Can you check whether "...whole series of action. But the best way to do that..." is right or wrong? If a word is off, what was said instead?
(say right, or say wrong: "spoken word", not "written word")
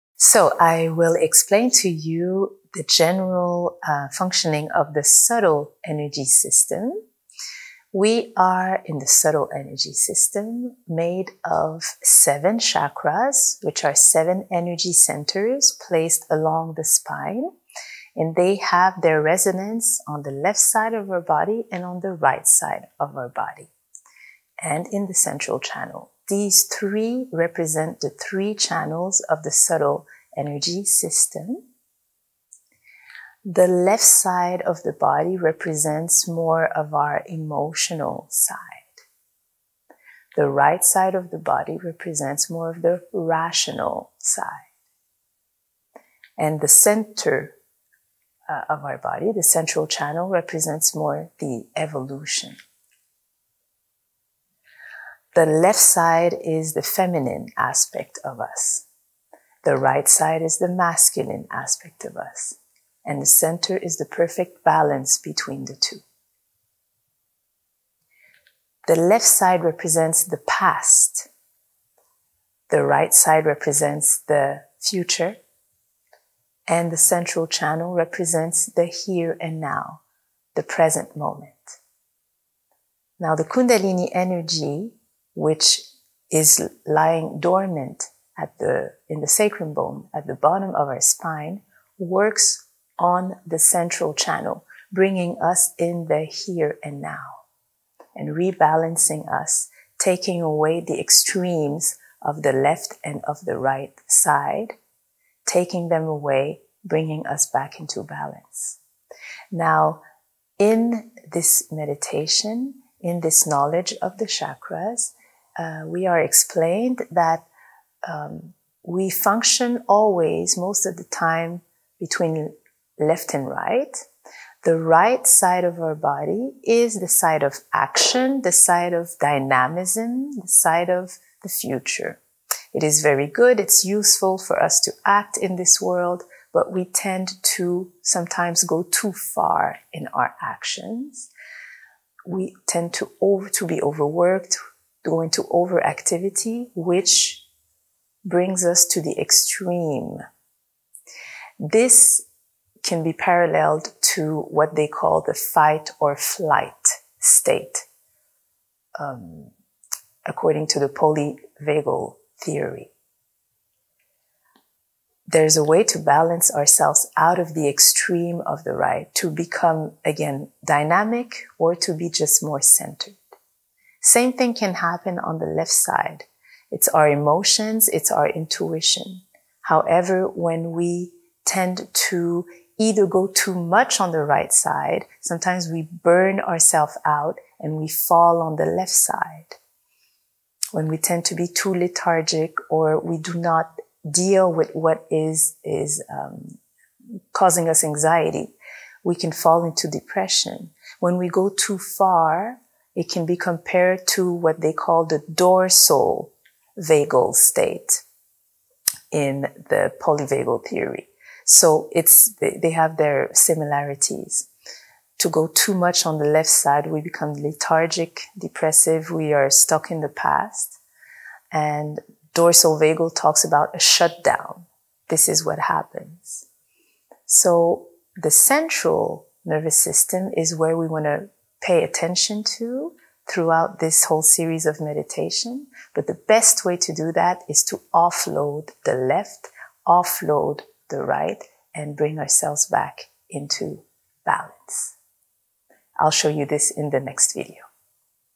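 wrong: "meditation", not "action".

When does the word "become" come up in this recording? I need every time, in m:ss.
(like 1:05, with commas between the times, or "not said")
2:49, 3:37.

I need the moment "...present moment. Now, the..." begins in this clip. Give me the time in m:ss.
1:20.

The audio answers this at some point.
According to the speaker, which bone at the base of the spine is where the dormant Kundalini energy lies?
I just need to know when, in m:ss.
1:29.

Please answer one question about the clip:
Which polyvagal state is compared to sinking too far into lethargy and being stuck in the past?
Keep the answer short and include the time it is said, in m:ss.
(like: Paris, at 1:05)
Dorsal vagal state, at 3:25.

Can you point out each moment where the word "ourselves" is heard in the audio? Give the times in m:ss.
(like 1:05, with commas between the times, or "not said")
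2:46, 3:06, 4:02.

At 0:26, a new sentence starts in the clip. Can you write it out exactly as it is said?
These three represent the three channels of the subtle energy system.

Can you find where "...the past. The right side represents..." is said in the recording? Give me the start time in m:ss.
1:10.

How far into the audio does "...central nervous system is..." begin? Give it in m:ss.
3:48.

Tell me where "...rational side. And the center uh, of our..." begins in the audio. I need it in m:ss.
0:43.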